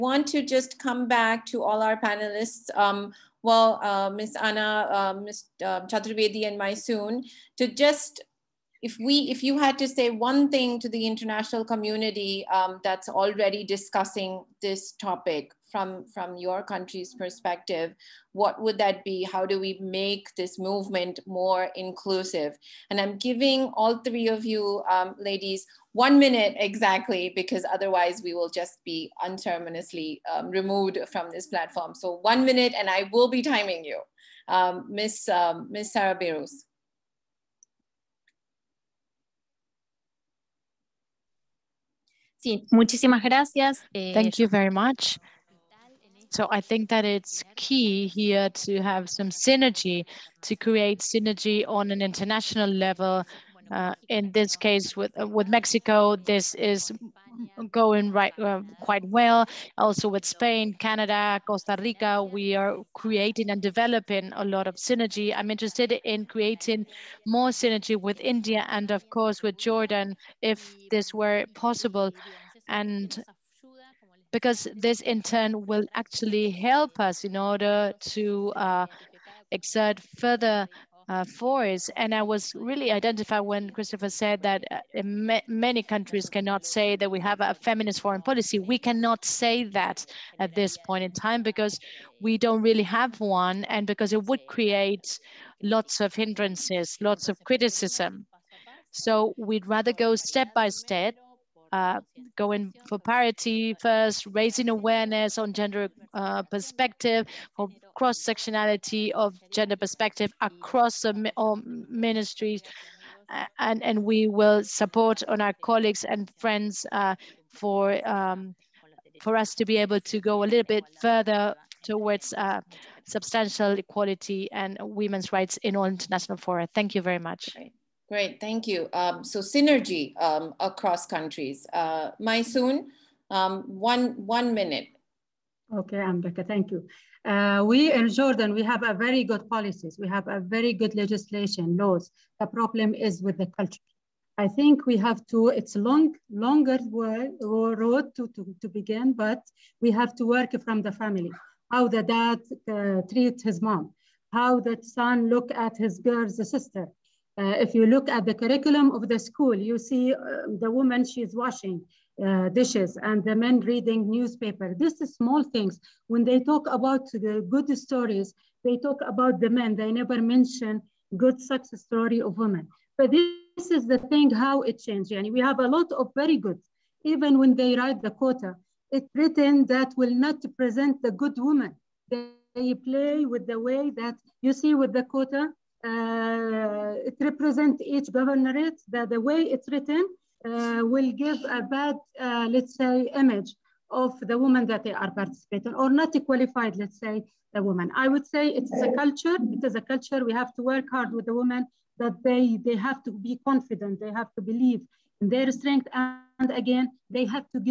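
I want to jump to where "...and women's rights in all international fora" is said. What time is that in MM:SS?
02:04.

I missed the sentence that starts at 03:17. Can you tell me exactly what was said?
I would say it is a culture.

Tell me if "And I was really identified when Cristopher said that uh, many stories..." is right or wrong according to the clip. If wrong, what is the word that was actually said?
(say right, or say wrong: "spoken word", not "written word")
wrong: "countries", not "stories".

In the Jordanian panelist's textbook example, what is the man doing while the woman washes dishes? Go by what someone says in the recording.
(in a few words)
Reading newspaper.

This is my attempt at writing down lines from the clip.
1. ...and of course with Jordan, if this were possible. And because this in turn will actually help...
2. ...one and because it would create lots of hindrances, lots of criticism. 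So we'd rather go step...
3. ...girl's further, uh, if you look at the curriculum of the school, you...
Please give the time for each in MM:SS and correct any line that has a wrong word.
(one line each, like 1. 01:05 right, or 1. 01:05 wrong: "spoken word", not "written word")
1. 01:08 right
2. 01:33 right
3. 02:35 wrong: "sister", not "further".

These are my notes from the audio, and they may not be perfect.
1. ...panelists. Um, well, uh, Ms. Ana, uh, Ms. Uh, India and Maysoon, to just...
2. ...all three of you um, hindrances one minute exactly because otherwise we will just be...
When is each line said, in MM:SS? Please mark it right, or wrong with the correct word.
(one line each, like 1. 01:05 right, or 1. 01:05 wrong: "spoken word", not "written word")
1. 00:01 wrong: "Chaturvedi", not "India"
2. 00:23 wrong: "ladies", not "hindrances".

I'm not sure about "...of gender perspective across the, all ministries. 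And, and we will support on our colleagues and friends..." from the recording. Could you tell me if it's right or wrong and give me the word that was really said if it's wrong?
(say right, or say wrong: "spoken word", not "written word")
right.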